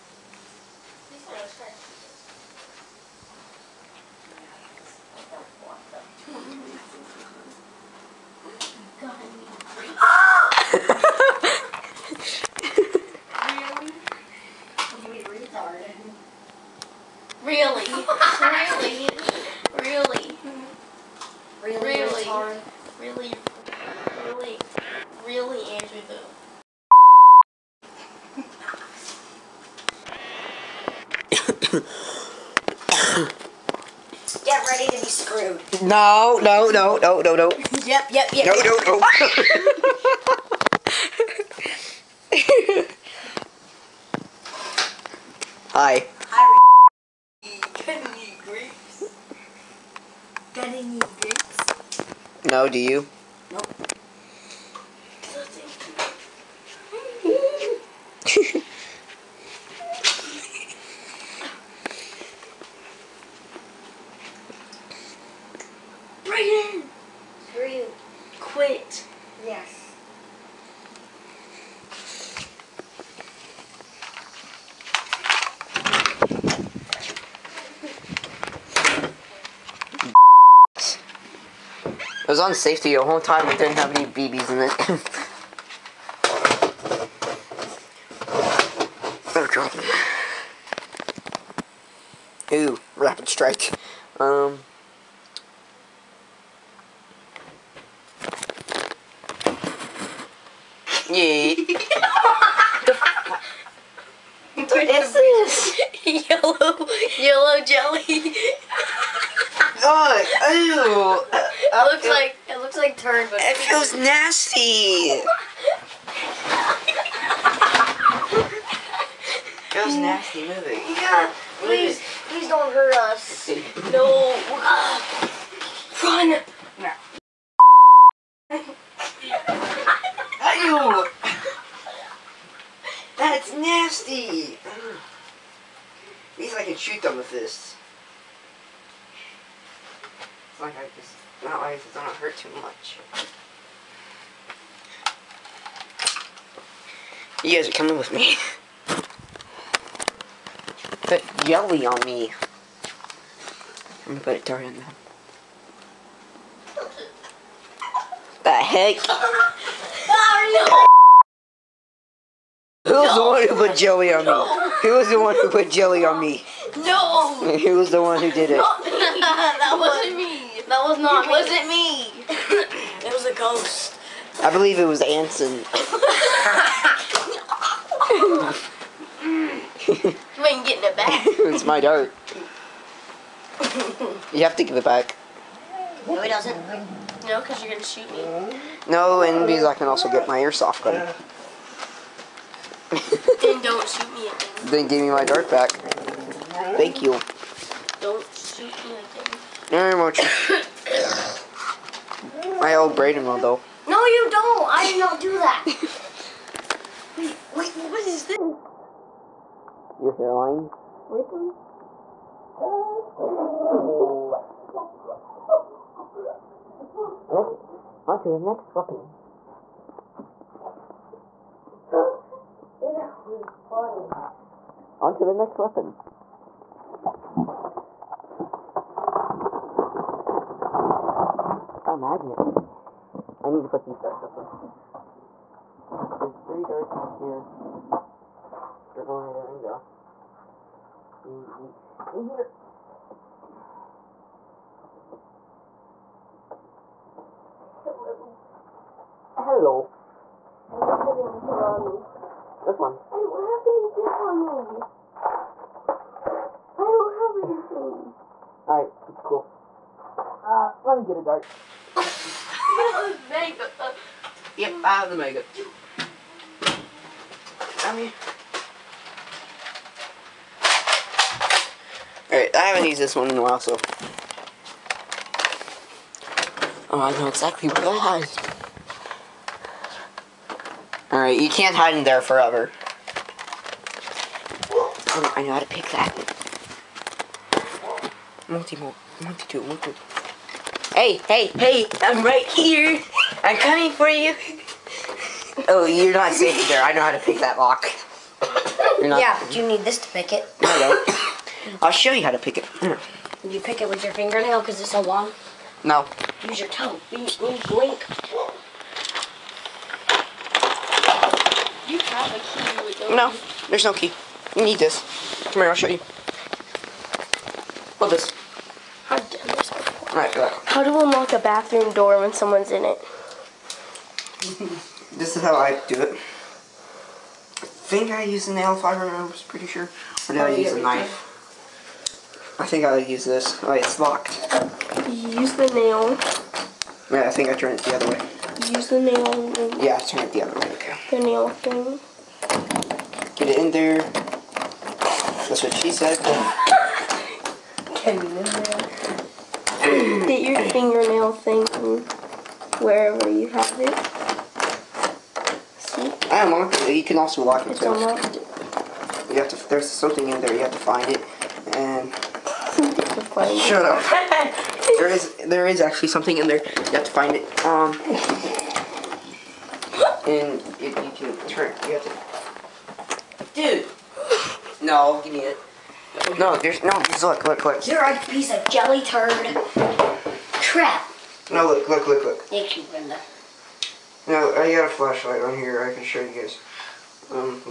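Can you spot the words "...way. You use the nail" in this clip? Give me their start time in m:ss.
5:38.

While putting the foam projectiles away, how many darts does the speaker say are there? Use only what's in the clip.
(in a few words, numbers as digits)
3.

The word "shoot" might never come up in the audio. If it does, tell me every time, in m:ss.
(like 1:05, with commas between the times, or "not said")
2:16, 3:07, 3:13, 3:18.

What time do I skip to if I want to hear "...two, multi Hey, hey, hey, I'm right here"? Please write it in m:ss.
4:49.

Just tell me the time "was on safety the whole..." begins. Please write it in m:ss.
1:22.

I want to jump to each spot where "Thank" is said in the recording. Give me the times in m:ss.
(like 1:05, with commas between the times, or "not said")
3:15, 6:22.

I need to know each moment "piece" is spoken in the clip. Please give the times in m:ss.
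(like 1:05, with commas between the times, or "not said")
6:18.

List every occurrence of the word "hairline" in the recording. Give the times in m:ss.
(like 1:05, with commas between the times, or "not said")
3:30.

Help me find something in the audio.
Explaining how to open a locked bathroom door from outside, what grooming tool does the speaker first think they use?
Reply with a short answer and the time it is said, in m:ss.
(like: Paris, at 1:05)
nail file, at 5:28.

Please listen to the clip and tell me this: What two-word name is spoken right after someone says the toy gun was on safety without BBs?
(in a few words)
rapid strike.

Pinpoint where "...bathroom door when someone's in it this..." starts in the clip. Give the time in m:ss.
5:21.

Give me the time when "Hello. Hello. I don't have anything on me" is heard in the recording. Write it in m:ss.
4:07.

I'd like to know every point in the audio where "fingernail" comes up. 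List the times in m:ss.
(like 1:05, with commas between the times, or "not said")
5:04, 5:50.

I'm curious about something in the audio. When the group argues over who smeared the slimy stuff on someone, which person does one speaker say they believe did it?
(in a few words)
Anson.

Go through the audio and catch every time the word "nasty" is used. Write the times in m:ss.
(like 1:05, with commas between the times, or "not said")
1:53, 1:59, 2:13.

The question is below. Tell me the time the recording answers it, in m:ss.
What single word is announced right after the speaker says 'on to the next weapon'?
3:52.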